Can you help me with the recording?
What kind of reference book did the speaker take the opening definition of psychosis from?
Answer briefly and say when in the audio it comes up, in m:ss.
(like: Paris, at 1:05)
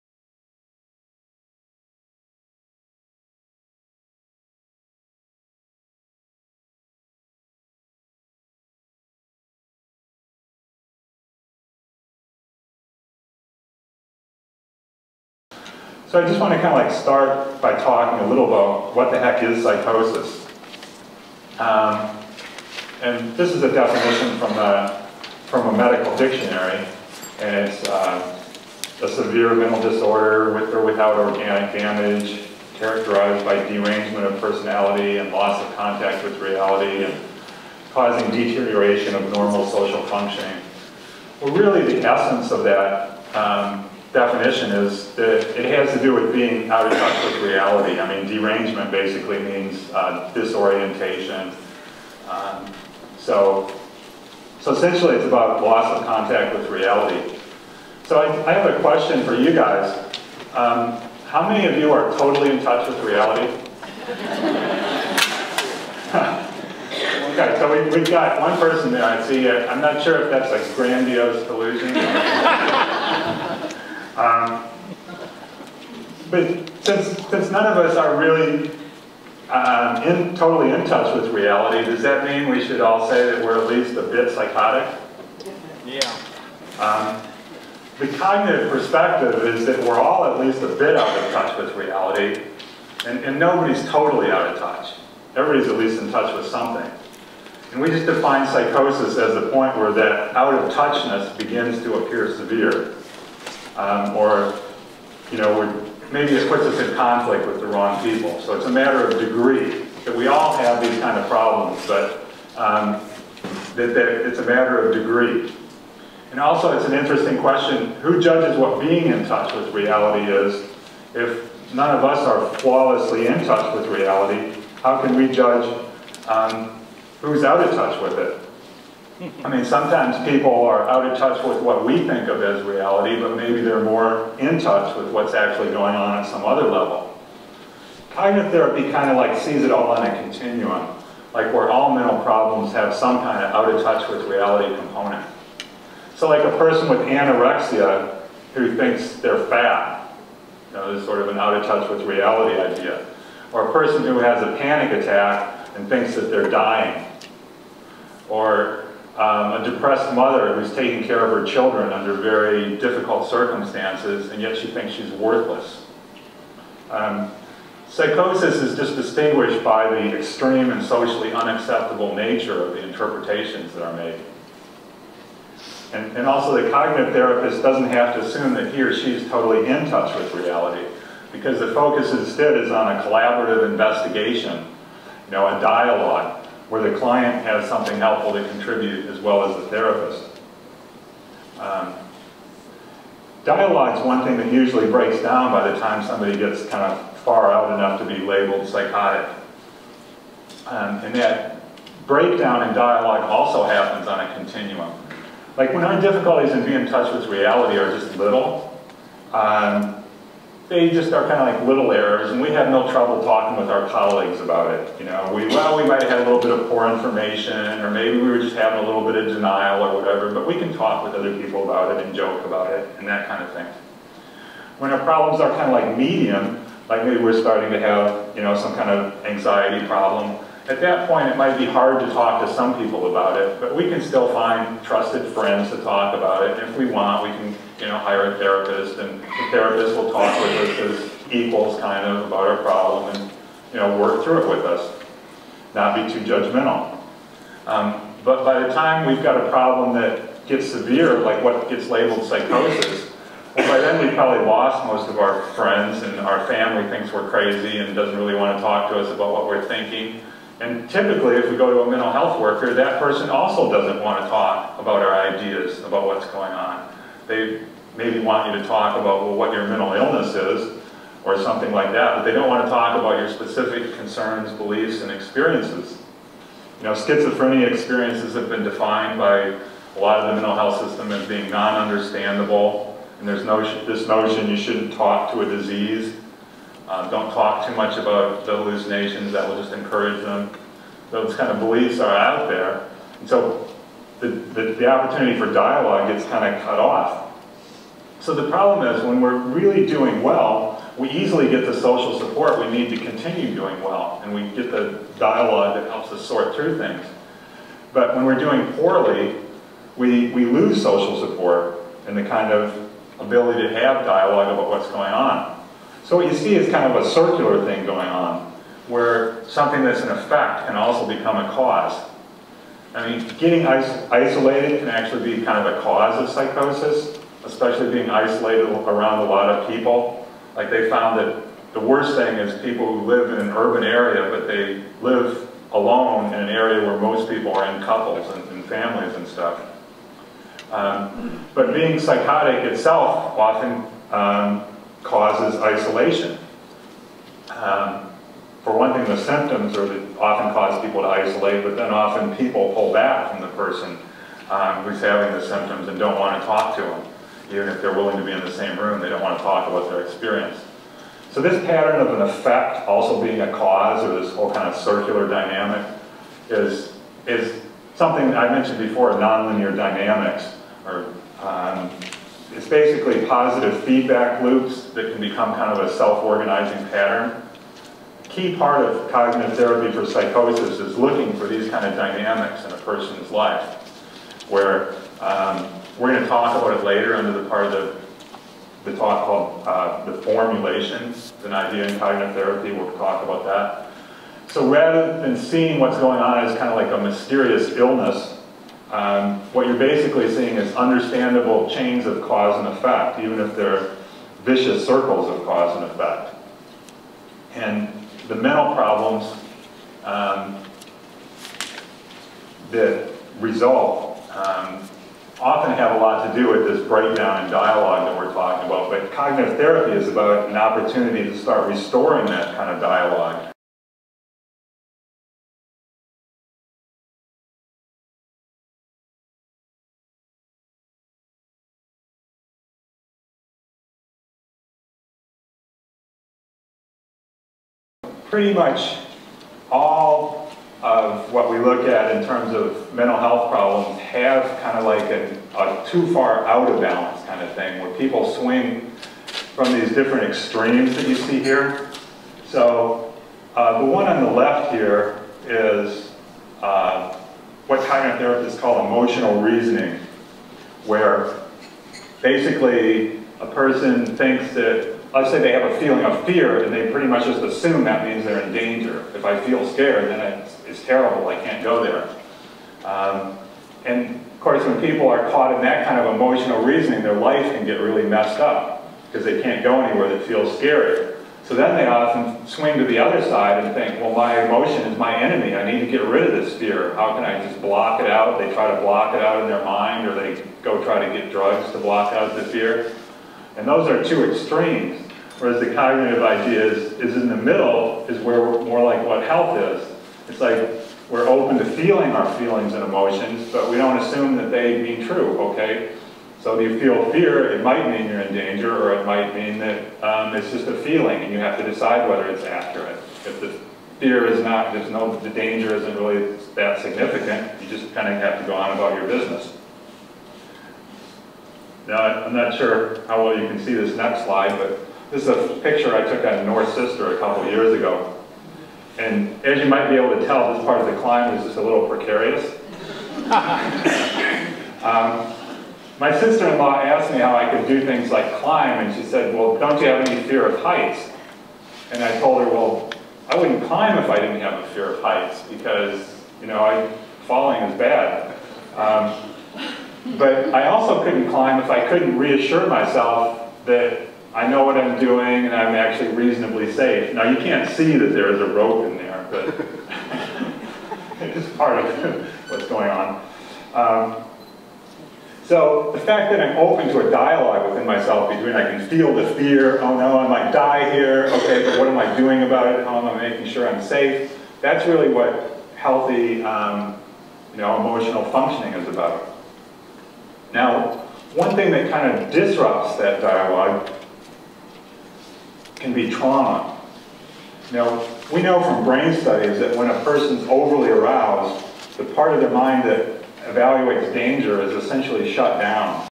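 Medical dictionary, at 0:25.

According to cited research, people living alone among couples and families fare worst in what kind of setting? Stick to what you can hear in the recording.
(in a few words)
Urban area.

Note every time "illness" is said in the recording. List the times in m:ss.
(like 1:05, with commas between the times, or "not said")
4:29, 6:37.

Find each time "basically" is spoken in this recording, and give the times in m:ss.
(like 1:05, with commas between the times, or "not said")
0:48, 6:12, 6:39, 7:42.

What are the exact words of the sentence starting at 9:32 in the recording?
How am I making sure I'm safe?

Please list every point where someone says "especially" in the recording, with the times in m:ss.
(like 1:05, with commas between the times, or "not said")
5:27.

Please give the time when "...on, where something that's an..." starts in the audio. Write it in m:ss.
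5:18.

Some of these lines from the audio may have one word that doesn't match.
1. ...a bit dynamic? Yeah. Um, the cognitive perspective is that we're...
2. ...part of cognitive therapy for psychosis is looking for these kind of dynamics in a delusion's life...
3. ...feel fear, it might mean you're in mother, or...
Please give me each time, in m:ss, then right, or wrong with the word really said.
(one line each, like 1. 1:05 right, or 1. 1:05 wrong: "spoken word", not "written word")
1. 1:23 wrong: "psychotic", not "dynamic"
2. 6:18 wrong: "person", not "delusion"
3. 8:26 wrong: "danger", not "mother".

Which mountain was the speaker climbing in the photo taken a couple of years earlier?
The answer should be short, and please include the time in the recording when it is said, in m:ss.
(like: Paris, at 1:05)
North Sister, at 8:46.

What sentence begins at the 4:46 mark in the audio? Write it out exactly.
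Uh, don't talk too much about the hallucinations, that will just encourage them.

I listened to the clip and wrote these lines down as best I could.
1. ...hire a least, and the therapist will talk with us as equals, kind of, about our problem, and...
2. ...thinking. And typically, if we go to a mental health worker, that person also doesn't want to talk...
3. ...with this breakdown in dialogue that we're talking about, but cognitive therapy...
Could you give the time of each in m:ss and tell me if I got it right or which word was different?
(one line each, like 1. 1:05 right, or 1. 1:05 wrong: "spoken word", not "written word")
1. 3:57 wrong: "therapist", not "least"
2. 4:19 right
3. 6:56 right.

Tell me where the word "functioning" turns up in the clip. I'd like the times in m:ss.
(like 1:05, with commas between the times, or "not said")
0:40, 9:38.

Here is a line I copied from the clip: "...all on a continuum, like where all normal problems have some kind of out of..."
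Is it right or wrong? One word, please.
wrong.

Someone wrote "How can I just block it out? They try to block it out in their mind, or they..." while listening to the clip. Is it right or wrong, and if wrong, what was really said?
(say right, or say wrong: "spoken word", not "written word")
right.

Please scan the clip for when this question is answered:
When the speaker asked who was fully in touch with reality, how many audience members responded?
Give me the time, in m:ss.
1:08.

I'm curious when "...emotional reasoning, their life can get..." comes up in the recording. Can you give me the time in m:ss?
7:56.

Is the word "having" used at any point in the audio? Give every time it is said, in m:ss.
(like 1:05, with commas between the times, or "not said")
3:38, 5:55.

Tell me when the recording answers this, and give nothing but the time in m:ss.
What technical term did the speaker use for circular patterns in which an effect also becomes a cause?
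6:09.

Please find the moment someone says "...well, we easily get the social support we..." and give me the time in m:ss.
5:00.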